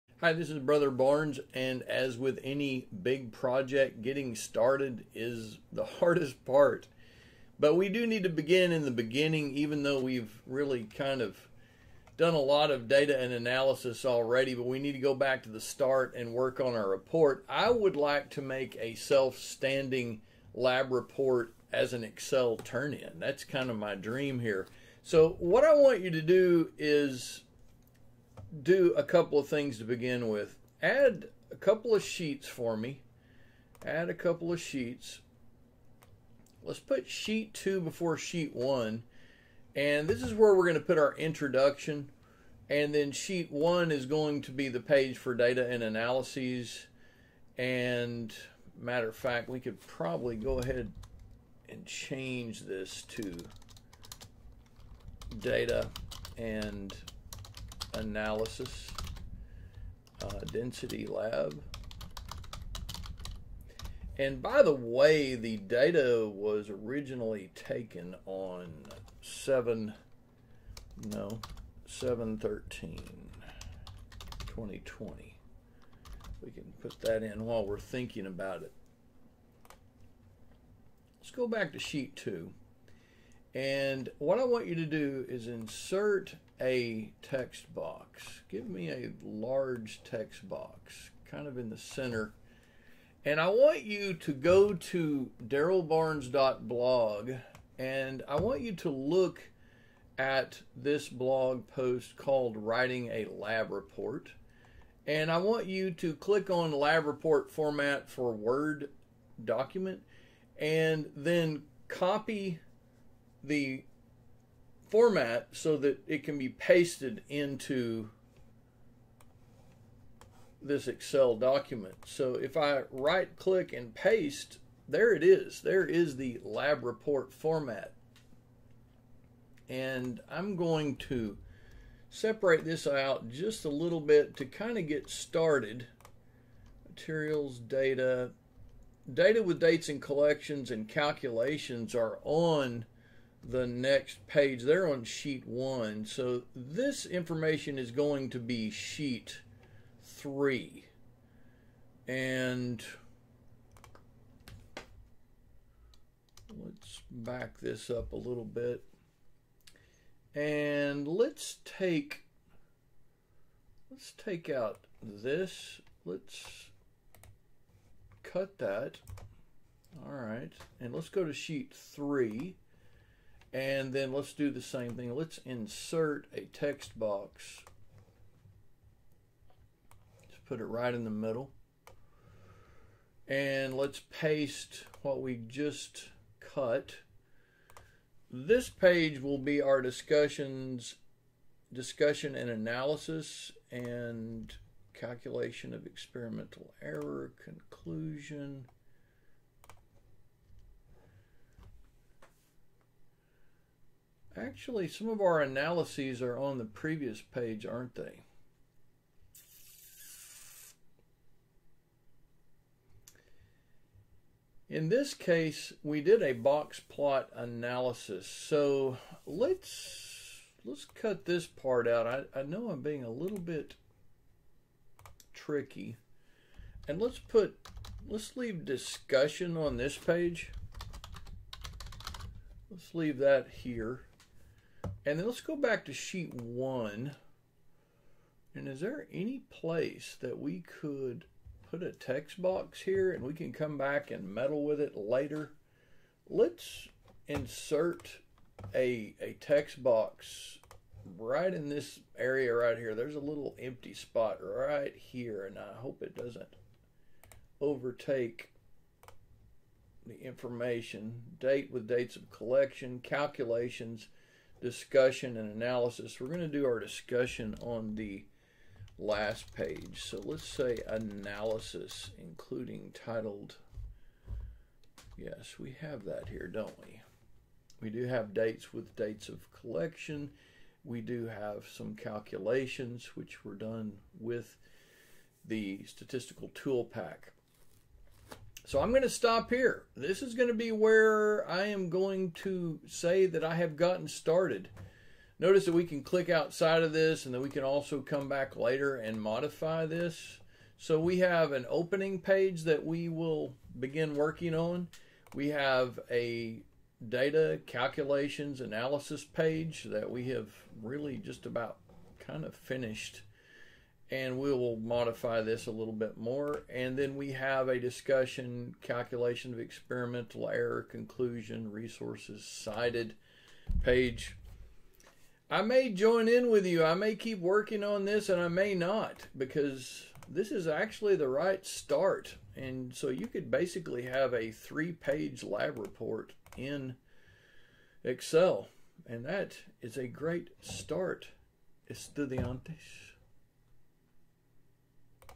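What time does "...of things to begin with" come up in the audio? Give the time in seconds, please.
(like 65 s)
29 s.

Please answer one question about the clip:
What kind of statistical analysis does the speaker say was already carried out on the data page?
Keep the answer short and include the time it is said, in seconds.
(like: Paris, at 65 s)
box plot, at 216 s.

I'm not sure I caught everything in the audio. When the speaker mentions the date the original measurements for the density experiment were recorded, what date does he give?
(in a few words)
7/13/2020.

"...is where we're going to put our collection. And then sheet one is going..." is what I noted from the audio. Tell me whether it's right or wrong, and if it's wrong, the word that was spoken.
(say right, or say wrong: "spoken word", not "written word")
wrong: "introduction", not "collection".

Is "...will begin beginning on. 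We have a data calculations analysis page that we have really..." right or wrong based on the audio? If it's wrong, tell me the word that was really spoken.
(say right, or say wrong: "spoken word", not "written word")
wrong: "working", not "beginning".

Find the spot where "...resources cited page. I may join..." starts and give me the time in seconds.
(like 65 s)
321 s.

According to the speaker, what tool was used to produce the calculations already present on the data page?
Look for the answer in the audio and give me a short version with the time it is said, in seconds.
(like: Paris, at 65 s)
statistical tool pack, at 285 s.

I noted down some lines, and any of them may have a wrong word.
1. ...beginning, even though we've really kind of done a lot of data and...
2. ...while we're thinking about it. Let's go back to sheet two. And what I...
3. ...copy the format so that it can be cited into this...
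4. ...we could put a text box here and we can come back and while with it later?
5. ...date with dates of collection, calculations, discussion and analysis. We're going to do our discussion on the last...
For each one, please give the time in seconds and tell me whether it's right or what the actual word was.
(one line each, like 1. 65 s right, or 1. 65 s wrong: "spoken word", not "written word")
1. 8 s right
2. 77 s right
3. 111 s wrong: "pasted", not "cited"
4. 240 s wrong: "meddle", not "while"
5. 261 s right.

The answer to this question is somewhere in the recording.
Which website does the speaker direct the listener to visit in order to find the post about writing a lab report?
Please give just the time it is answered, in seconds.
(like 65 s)
95 s.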